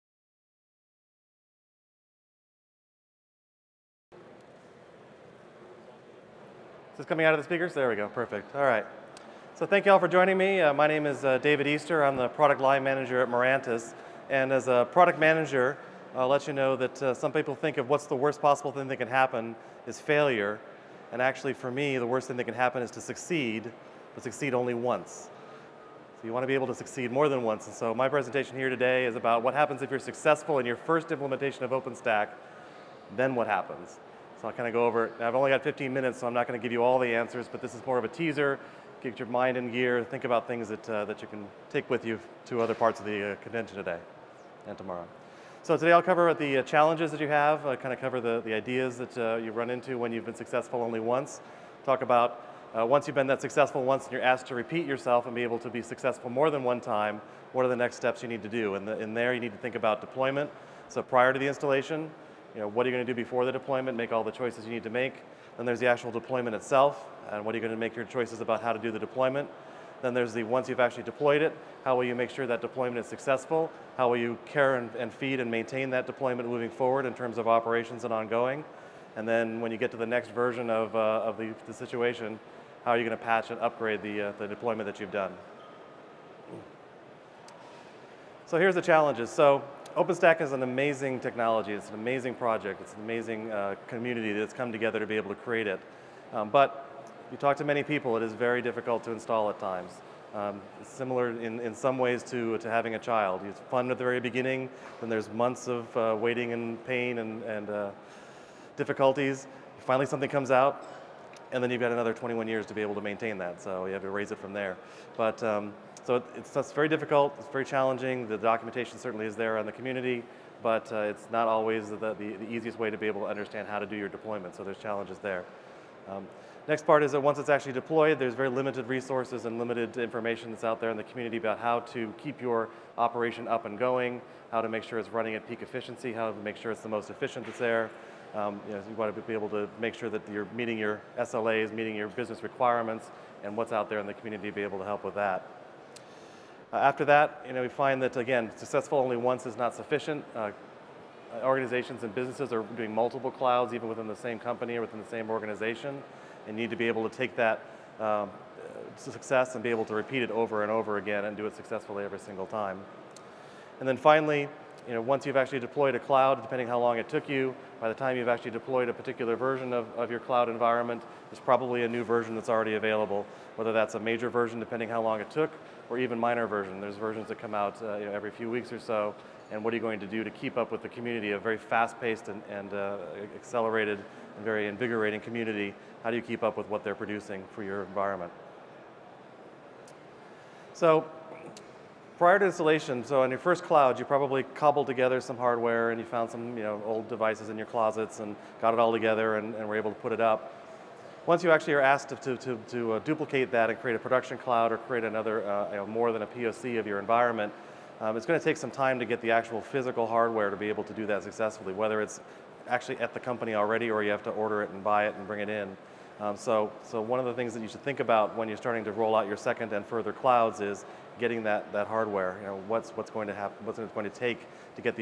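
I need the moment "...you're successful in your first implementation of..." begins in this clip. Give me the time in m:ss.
0:29.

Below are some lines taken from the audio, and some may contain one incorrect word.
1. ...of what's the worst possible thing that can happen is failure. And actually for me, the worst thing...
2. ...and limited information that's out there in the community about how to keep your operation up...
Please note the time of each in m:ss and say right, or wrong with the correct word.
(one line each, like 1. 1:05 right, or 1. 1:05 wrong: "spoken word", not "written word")
1. 0:17 right
2. 2:09 right.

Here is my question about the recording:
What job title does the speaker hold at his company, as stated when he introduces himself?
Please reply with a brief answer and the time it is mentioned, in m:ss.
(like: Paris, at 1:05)
Product line manager, at 0:12.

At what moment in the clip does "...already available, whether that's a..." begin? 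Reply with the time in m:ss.
2:52.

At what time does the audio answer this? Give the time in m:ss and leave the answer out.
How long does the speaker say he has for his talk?
0:35.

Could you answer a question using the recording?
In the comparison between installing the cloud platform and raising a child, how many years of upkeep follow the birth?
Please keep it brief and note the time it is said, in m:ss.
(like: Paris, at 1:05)
21 years, at 1:52.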